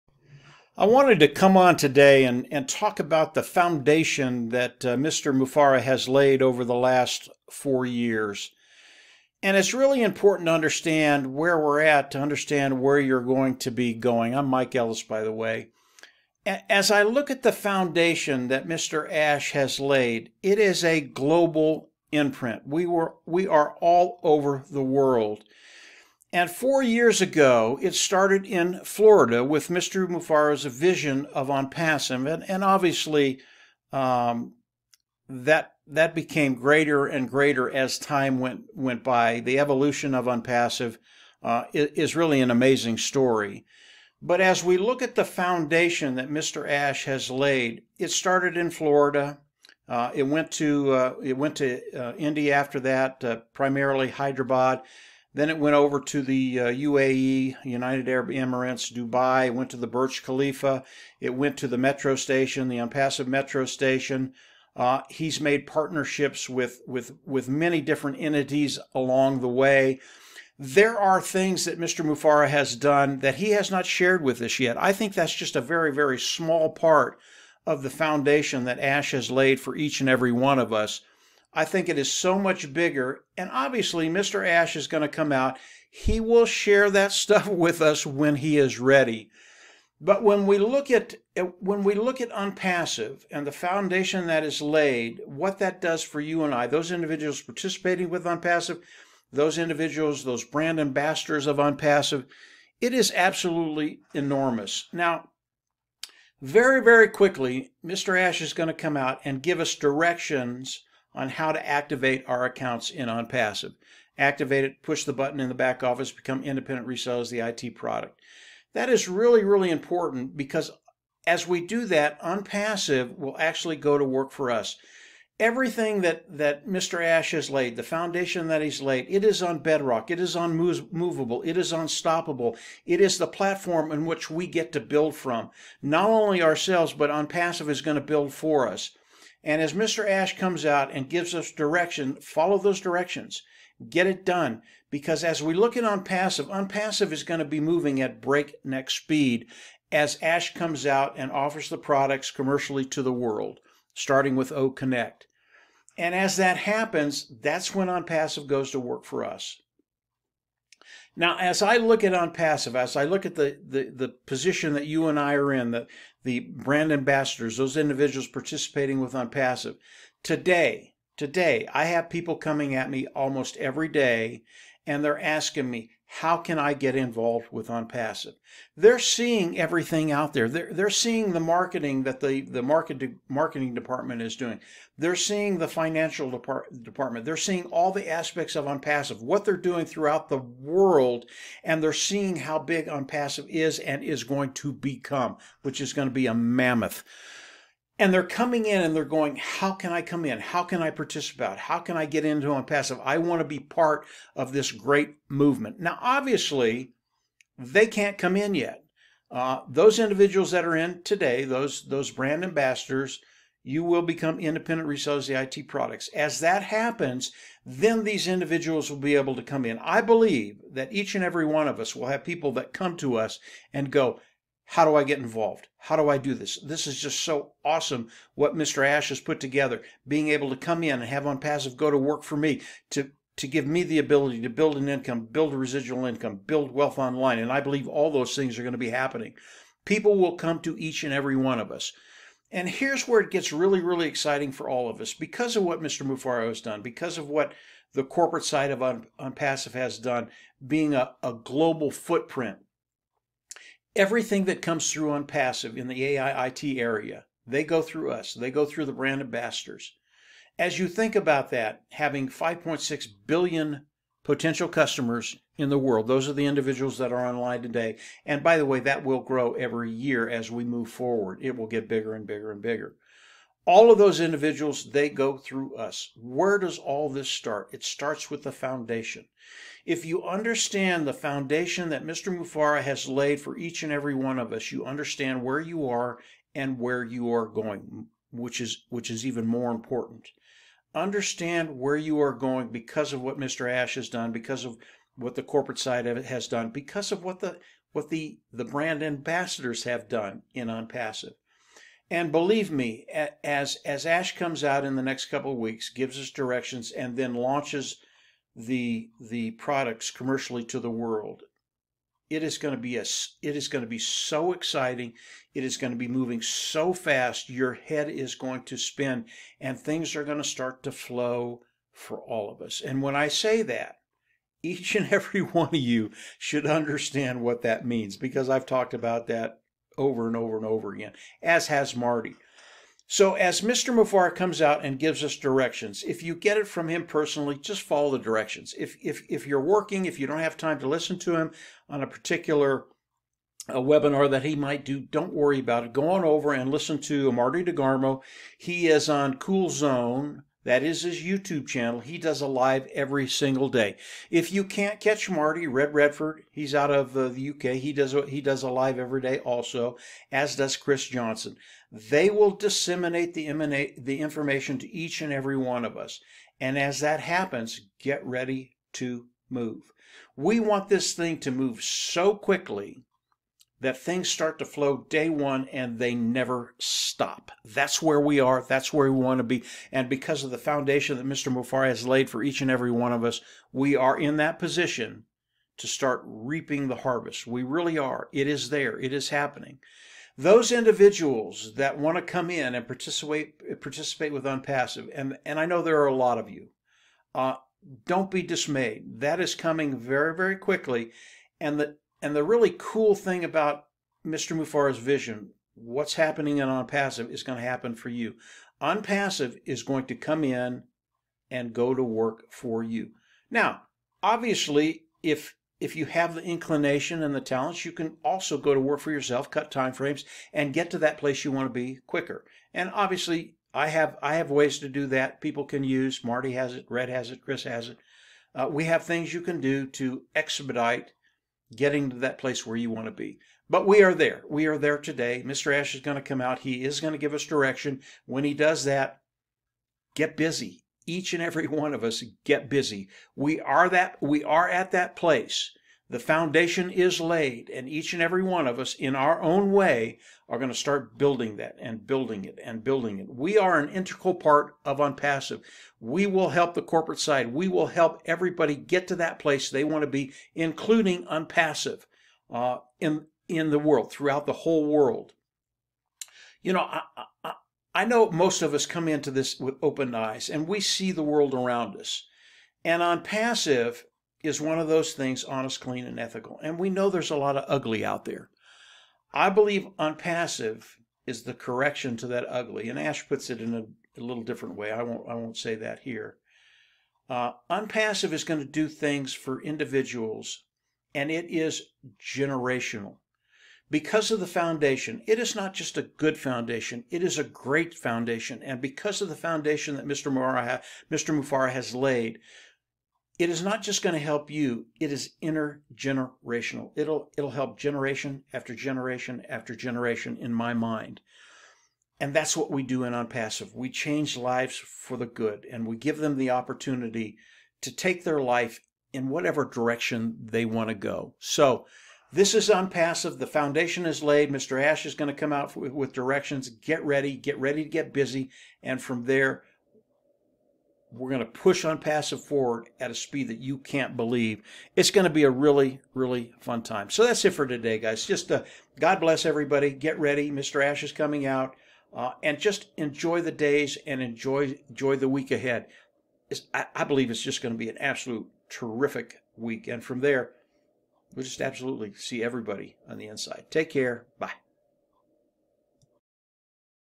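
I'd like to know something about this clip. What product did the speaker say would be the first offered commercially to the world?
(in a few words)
O Connect.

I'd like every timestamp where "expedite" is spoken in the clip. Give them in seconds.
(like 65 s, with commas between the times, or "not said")
430 s.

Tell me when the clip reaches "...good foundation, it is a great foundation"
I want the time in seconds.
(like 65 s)
496 s.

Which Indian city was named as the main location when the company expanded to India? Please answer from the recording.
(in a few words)
Hyderabad.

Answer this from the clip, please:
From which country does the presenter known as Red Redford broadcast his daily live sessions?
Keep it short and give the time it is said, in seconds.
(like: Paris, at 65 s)
UK, at 357 s.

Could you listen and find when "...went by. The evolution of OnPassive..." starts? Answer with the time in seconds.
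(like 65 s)
38 s.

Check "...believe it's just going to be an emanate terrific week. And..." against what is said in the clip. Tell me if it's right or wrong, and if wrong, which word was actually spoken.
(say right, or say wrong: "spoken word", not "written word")
wrong: "absolute", not "emanate".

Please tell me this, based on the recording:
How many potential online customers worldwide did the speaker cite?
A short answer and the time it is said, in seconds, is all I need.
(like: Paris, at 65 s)
5.6 billion, at 262 s.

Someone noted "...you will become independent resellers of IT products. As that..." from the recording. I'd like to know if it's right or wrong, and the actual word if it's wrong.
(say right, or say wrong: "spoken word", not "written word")
right.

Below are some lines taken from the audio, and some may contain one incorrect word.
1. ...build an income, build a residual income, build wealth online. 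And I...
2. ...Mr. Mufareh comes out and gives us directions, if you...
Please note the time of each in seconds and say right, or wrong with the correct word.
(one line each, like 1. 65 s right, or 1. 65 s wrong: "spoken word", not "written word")
1. 234 s right
2. 333 s right.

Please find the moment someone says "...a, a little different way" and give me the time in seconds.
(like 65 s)
483 s.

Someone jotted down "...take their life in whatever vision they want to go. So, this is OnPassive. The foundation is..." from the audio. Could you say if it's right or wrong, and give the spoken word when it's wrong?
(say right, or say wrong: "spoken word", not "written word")
wrong: "direction", not "vision".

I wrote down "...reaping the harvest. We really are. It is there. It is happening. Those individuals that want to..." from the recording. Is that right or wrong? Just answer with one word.
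right.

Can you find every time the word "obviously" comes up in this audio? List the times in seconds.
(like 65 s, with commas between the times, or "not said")
32 s, 83 s, 206 s, 414 s, 422 s.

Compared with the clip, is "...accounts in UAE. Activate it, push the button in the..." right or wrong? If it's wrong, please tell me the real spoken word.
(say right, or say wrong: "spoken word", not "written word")
wrong: "OnPassive", not "UAE".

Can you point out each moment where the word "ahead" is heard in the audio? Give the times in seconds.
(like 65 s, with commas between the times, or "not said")
545 s.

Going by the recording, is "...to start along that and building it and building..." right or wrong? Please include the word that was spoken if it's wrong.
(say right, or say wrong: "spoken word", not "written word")
wrong: "building", not "along".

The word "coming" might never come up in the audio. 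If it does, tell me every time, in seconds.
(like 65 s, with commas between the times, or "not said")
172 s, 198 s, 399 s, 541 s.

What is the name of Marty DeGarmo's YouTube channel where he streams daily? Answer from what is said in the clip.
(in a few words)
Cool Zone.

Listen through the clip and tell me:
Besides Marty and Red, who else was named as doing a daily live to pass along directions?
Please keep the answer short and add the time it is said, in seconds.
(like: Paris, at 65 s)
Chris Johnson, at 360 s.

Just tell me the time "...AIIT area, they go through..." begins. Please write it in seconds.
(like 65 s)
256 s.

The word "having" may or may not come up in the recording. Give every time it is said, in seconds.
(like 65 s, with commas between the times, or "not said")
261 s.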